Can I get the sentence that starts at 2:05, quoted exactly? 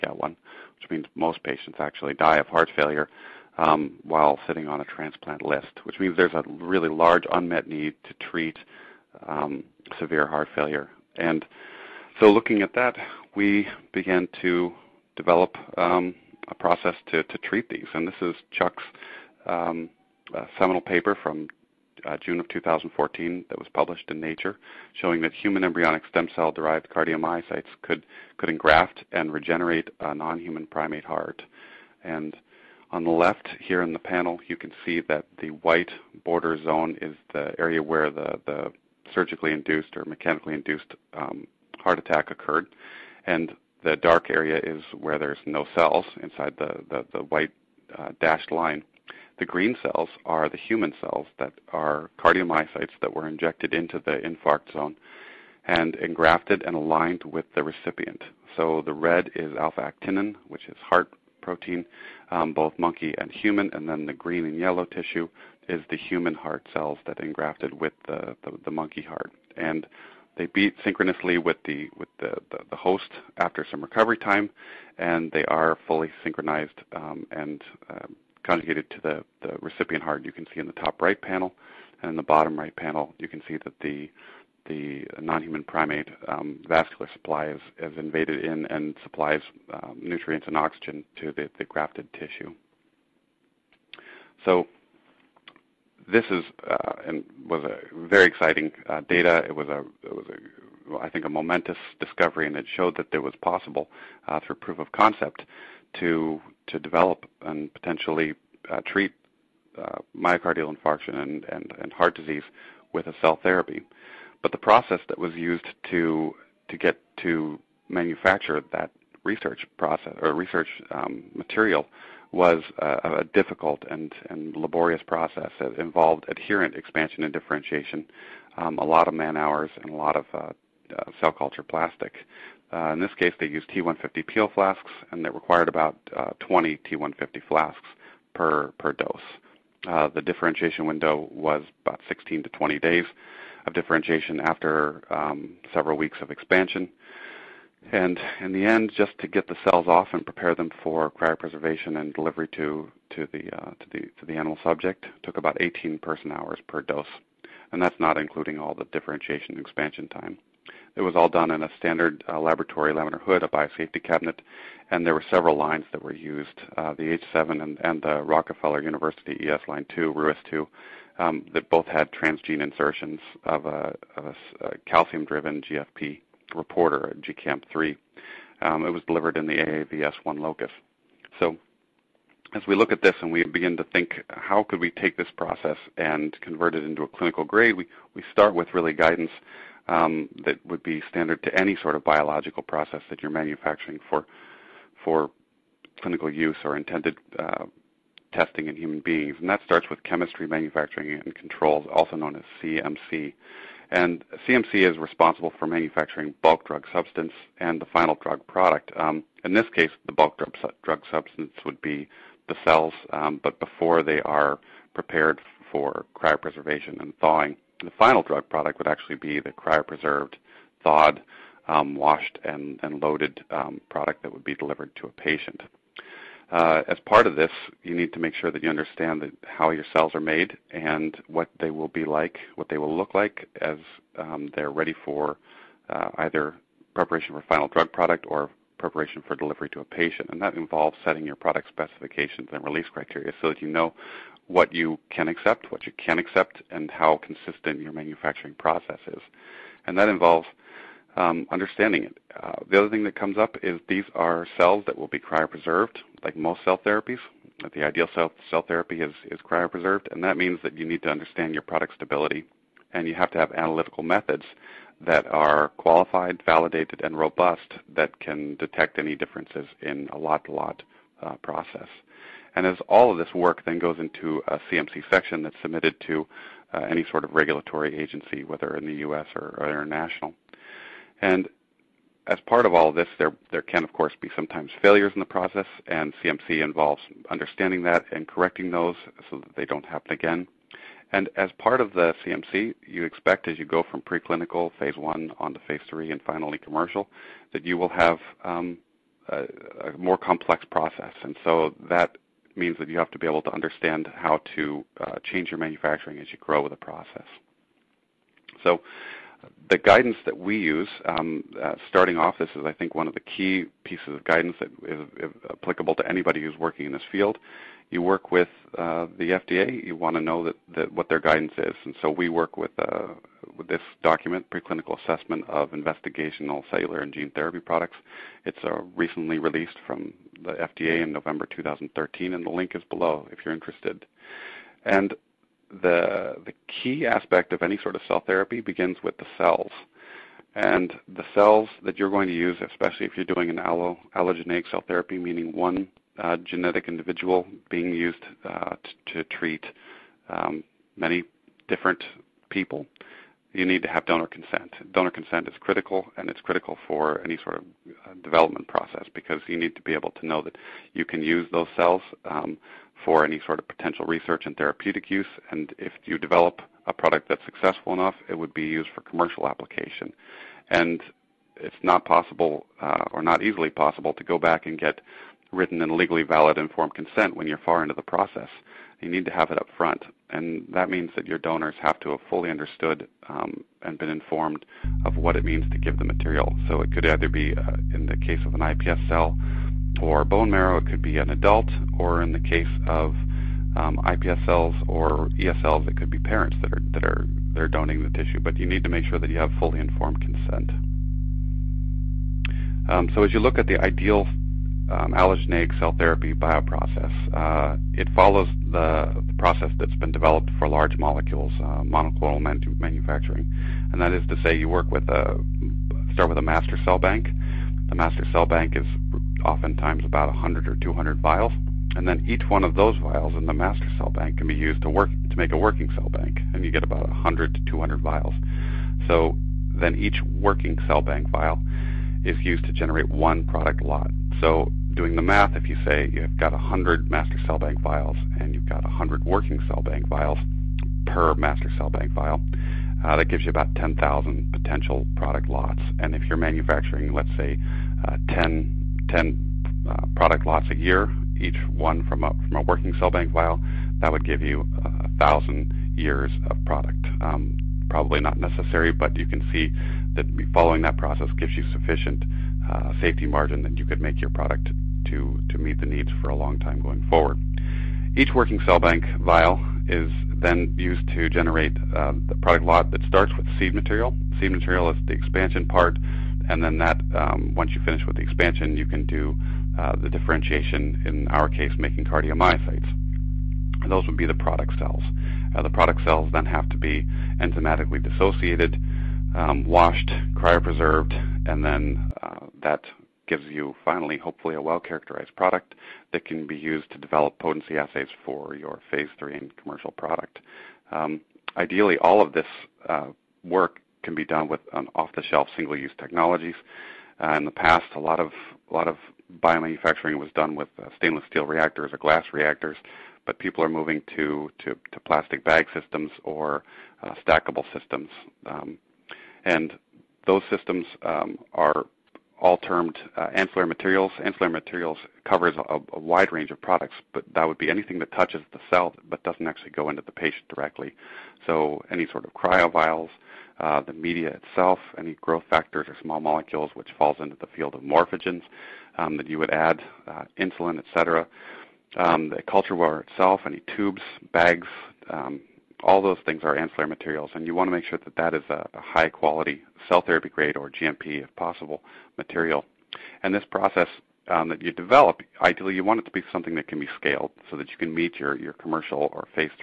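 It involved adherent expansion and differentiation, um, a lot of man hours, and a lot of uh, uh, cell culture plastic.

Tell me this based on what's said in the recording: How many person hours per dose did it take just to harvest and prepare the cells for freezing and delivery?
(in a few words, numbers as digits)
18.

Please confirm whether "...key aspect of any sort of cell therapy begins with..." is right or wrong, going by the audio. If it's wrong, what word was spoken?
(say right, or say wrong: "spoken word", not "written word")
right.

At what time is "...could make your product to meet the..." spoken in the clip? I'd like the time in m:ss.
7:43.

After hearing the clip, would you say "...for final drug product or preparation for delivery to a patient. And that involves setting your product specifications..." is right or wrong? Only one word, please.
right.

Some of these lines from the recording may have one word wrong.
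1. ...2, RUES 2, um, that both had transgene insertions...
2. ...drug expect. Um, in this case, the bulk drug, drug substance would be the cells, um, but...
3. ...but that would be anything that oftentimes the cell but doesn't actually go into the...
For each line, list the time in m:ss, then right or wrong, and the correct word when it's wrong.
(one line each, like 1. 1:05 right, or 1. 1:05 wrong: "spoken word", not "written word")
1. 2:49 right
2. 3:28 wrong: "product", not "expect"
3. 8:47 wrong: "touches", not "oftentimes".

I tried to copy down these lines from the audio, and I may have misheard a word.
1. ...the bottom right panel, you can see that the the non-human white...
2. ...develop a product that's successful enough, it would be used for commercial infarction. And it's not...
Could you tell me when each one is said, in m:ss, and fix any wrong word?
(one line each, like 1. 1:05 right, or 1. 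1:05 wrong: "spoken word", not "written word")
1. 1:22 wrong: "primate", not "white"
2. 6:06 wrong: "application", not "infarction".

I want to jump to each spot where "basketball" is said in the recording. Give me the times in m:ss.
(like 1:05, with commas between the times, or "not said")
not said.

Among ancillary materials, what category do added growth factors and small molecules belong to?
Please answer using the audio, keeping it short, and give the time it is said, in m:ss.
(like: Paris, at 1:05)
morphogens, at 8:57.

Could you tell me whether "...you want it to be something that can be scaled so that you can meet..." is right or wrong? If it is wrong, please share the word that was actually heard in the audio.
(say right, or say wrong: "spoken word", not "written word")
right.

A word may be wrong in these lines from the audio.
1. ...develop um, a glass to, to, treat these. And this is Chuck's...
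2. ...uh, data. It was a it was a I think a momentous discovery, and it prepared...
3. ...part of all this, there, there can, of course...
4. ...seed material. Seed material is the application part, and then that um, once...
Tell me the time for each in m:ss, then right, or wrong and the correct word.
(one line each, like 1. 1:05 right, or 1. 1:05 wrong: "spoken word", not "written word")
1. 0:15 wrong: "process", not "glass"
2. 1:38 wrong: "showed", not "prepared"
3. 4:42 right
4. 7:53 wrong: "expansion", not "application".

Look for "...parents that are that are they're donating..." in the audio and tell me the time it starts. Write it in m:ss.
6:36.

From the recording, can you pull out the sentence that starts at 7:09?
So then each working cell bank vial is used to generate one product lot.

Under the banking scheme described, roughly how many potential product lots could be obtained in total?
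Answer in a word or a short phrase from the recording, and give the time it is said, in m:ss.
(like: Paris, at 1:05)
10,000, at 7:23.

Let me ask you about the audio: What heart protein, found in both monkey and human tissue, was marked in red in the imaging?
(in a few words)
alpha actinin.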